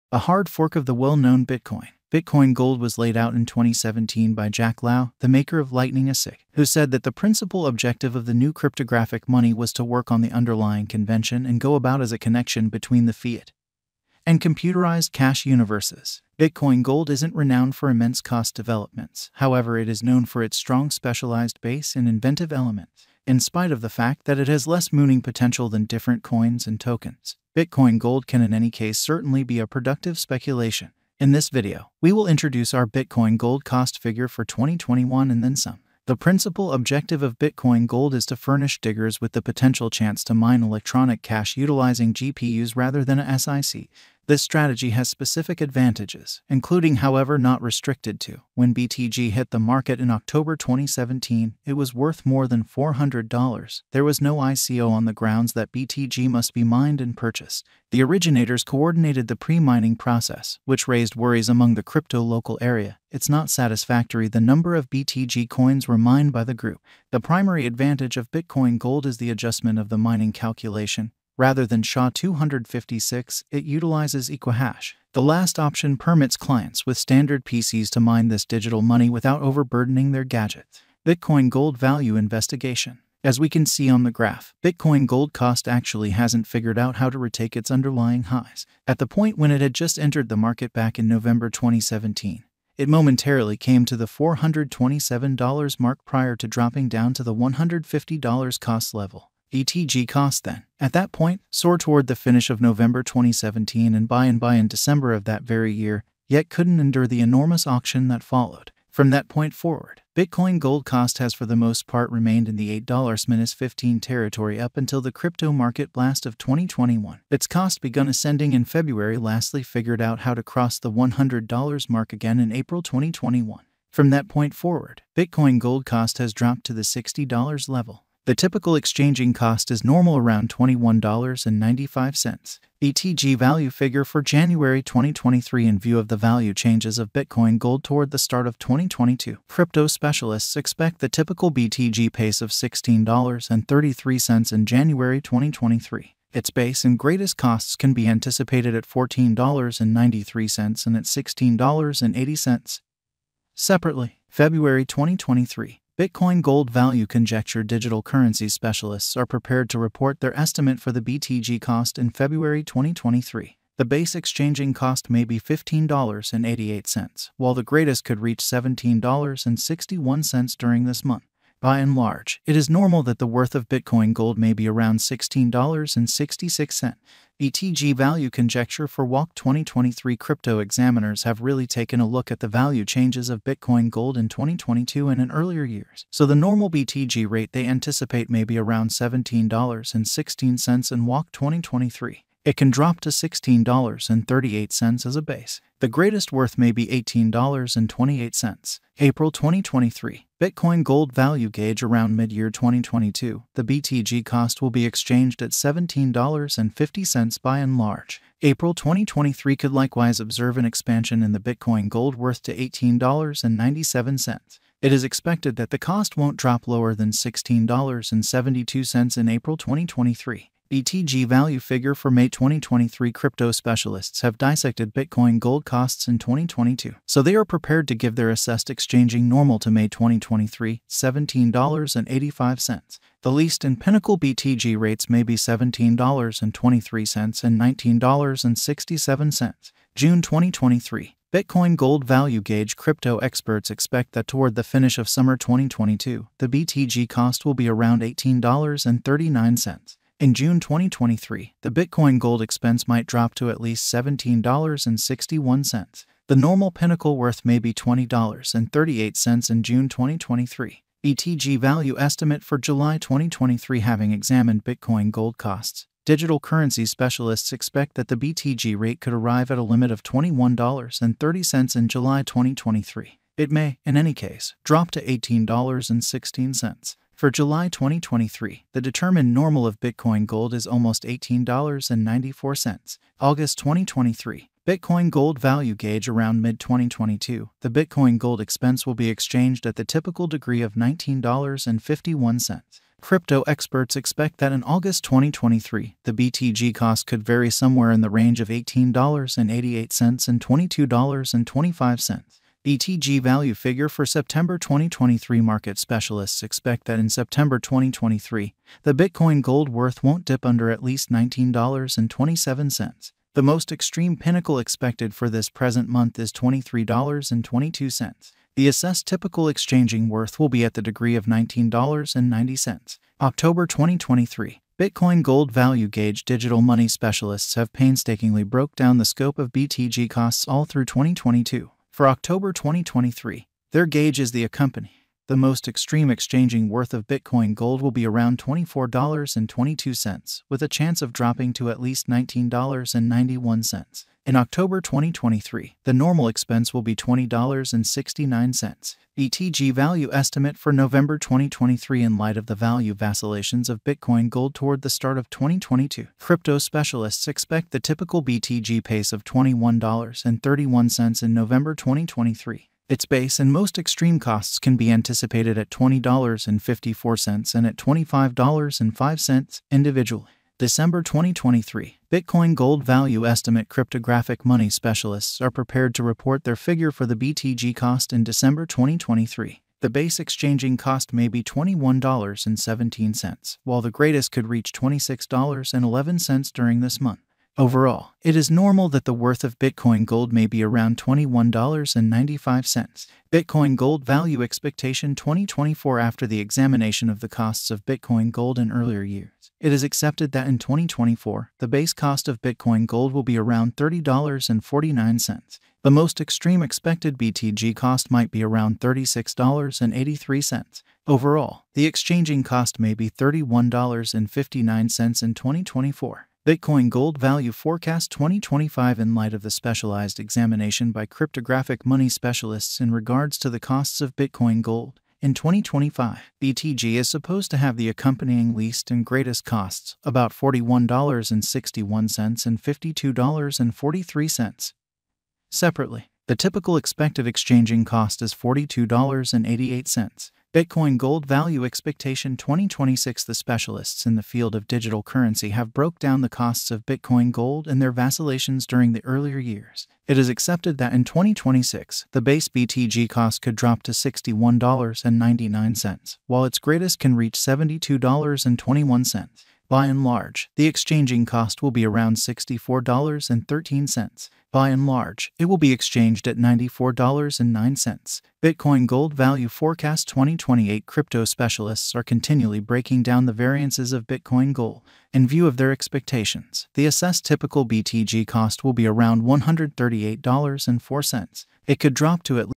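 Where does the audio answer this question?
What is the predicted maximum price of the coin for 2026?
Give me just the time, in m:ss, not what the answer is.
7:37.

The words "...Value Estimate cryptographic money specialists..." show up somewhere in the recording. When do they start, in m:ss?
6:12.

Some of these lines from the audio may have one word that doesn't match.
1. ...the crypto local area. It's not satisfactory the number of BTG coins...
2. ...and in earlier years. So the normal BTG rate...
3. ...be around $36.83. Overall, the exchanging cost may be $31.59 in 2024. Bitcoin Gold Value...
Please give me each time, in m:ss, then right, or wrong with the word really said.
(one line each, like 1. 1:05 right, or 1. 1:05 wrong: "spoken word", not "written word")
1. 1:01 right
2. 3:05 right
3. 6:48 right.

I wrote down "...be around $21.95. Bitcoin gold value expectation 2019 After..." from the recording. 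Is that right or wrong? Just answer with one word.
wrong.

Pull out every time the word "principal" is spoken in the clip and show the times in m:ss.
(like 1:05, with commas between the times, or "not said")
0:07, 0:36.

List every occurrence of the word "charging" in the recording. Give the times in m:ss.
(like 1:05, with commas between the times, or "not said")
not said.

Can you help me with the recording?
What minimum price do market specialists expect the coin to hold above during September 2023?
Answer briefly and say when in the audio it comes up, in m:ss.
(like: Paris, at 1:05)
$19.27, at 5:11.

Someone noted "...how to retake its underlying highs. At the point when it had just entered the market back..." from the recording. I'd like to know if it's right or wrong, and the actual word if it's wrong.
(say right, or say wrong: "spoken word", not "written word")
right.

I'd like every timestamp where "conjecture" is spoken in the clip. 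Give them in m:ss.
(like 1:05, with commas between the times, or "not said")
2:37, 2:58.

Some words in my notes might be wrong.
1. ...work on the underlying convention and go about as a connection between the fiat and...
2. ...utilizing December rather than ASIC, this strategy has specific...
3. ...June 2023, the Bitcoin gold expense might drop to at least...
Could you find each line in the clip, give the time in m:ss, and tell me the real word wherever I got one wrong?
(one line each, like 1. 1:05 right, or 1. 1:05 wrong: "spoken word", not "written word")
1. 0:09 right
2. 0:41 wrong: "GPUs", not "December"
3. 4:10 right.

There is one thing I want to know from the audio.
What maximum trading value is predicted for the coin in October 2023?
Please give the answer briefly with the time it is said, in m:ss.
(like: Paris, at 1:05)
$24.22, at 5:38.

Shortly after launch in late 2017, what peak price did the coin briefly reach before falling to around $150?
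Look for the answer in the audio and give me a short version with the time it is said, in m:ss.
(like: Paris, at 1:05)
$427, at 1:34.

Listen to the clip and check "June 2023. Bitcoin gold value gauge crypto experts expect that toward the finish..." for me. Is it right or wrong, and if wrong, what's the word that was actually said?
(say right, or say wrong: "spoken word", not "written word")
right.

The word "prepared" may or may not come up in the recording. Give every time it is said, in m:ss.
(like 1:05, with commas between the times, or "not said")
2:39, 3:47, 6:15.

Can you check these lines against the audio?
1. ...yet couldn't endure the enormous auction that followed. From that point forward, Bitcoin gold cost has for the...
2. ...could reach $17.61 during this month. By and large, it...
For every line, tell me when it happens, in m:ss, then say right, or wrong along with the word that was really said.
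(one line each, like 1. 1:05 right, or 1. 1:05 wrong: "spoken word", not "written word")
1. 1:46 right
2. 2:48 right.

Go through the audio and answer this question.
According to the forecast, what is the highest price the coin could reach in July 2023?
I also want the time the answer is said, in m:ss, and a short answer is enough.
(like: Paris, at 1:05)
$21.30, at 4:30.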